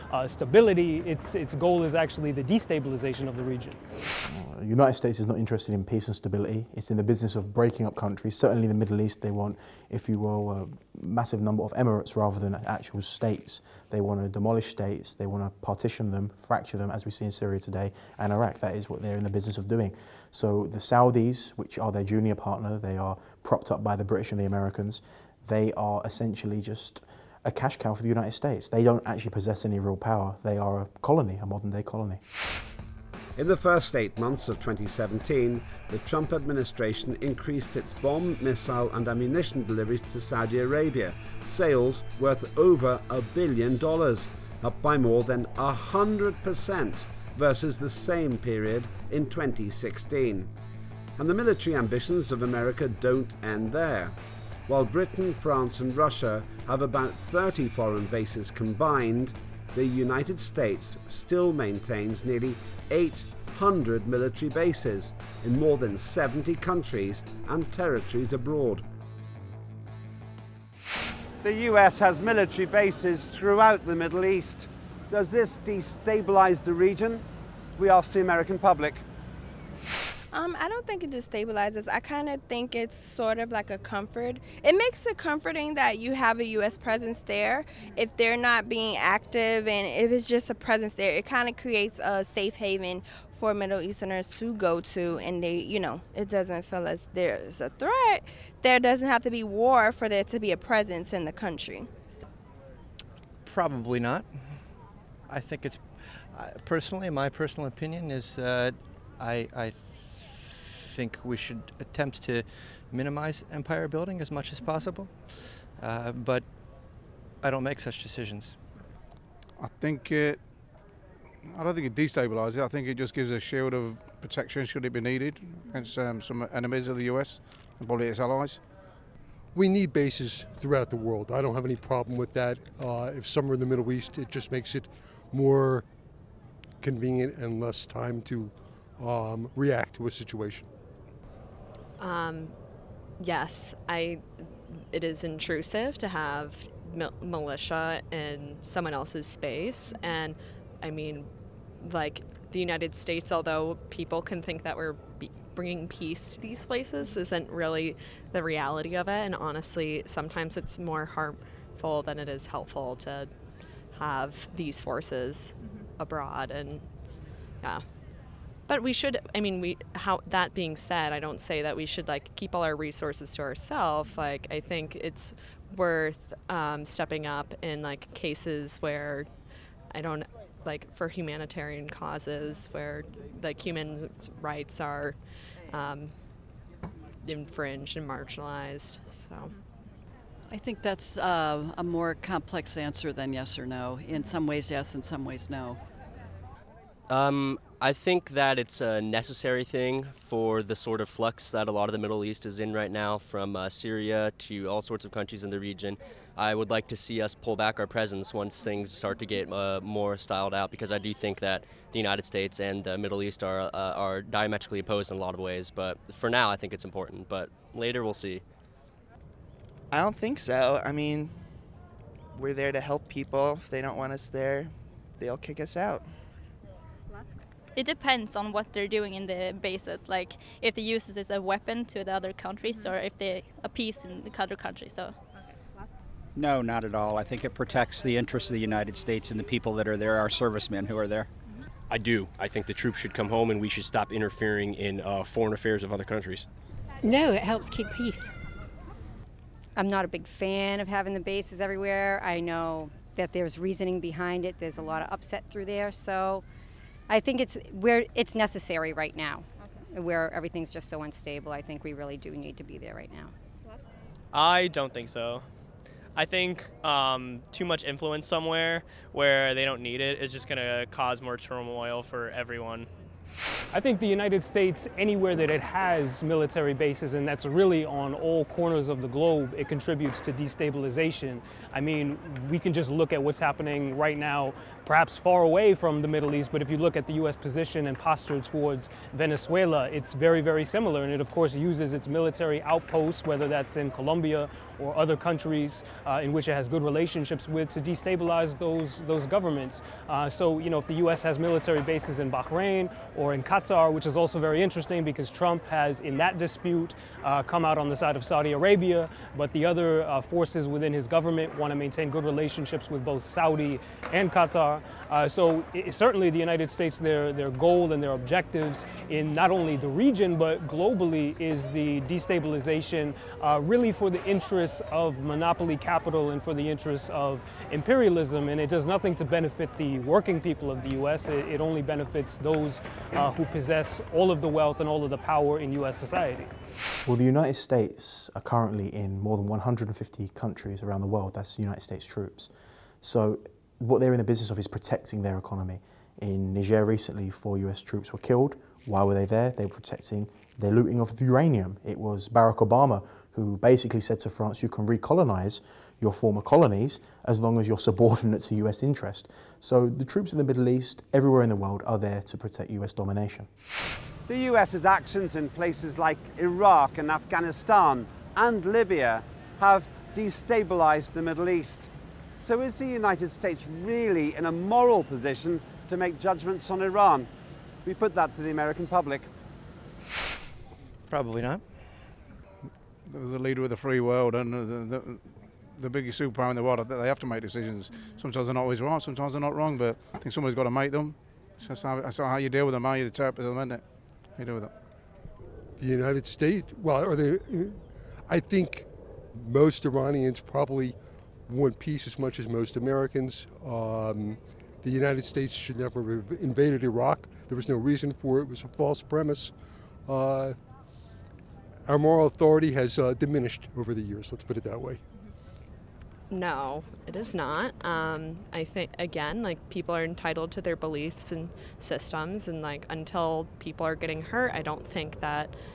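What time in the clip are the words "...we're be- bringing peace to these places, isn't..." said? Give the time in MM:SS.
02:34.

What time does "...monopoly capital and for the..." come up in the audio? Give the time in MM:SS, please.
05:25.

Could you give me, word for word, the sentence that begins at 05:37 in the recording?
Well, the United States are currently in more than 150 countries around the world.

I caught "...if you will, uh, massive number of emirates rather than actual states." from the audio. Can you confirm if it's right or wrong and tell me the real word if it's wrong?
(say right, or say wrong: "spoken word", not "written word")
right.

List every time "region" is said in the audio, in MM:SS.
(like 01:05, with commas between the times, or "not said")
00:03, 01:16, 03:25, 05:19.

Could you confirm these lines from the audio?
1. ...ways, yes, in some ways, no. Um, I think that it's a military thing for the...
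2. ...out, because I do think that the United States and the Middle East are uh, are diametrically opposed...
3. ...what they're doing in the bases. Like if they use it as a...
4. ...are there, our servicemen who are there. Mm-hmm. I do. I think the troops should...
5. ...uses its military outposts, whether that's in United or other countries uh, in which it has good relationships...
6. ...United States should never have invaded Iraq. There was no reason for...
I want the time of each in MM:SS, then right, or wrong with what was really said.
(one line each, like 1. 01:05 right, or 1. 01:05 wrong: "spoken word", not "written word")
1. 03:14 wrong: "necessary", not "military"
2. 03:30 right
3. 03:48 right
4. 03:59 right
5. 04:51 wrong: "Colombia", not "United"
6. 06:44 right.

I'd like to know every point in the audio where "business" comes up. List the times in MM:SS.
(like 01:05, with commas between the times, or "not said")
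00:07, 00:19, 05:44.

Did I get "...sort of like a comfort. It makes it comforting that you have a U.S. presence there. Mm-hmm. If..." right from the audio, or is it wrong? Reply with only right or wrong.
right.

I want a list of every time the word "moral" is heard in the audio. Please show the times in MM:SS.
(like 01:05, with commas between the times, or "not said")
06:14, 06:51.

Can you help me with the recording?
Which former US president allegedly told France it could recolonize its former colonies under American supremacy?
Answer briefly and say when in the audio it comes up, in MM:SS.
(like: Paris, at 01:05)
Barack Obama, at 05:52.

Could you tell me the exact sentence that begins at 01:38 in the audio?
There doesn't have to be war for there to be a presence in the country.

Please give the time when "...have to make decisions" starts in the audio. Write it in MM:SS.
06:27.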